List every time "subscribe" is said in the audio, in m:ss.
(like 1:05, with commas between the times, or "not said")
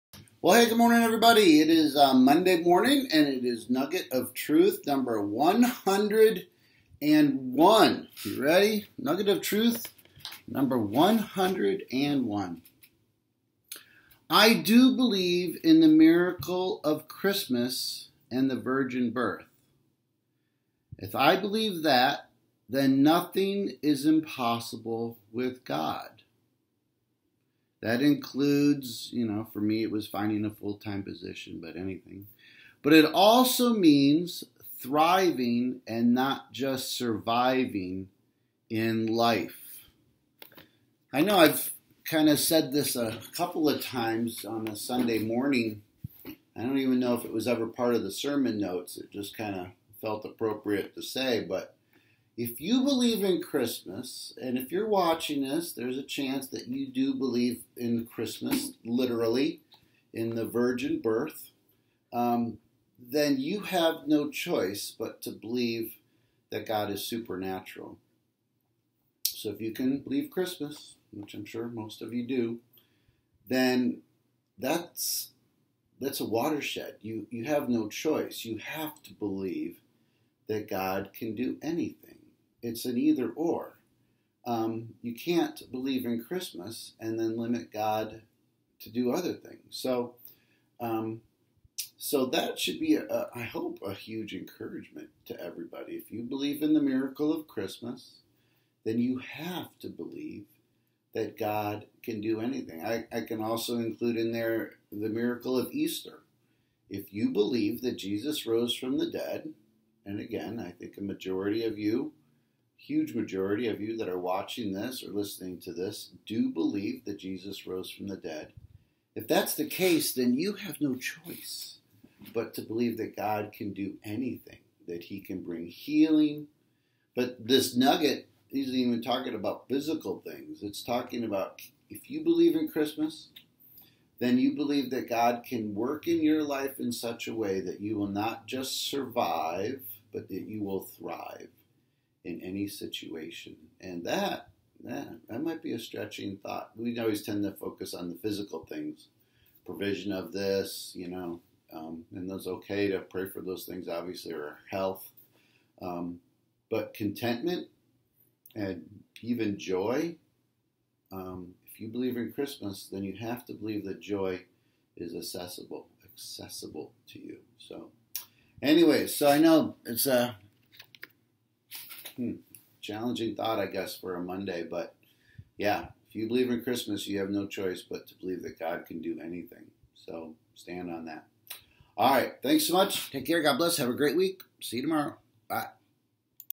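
not said.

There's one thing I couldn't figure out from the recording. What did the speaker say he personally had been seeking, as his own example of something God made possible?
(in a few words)
a full time position.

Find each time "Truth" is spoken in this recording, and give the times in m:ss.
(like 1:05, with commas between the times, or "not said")
0:04, 0:09.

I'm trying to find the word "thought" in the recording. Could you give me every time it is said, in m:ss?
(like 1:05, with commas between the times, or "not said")
2:26, 2:53.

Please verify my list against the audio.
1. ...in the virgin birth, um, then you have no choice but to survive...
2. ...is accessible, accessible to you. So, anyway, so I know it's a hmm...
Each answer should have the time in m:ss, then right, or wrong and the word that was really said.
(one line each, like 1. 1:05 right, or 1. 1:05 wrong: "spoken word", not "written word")
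1. 1:00 wrong: "believe", not "survive"
2. 2:44 right.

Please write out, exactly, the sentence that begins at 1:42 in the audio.
I, I can also include in there the miracle of Easter.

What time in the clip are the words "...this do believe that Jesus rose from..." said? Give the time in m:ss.
1:55.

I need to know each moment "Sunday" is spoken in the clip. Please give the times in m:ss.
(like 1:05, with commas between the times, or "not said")
0:44.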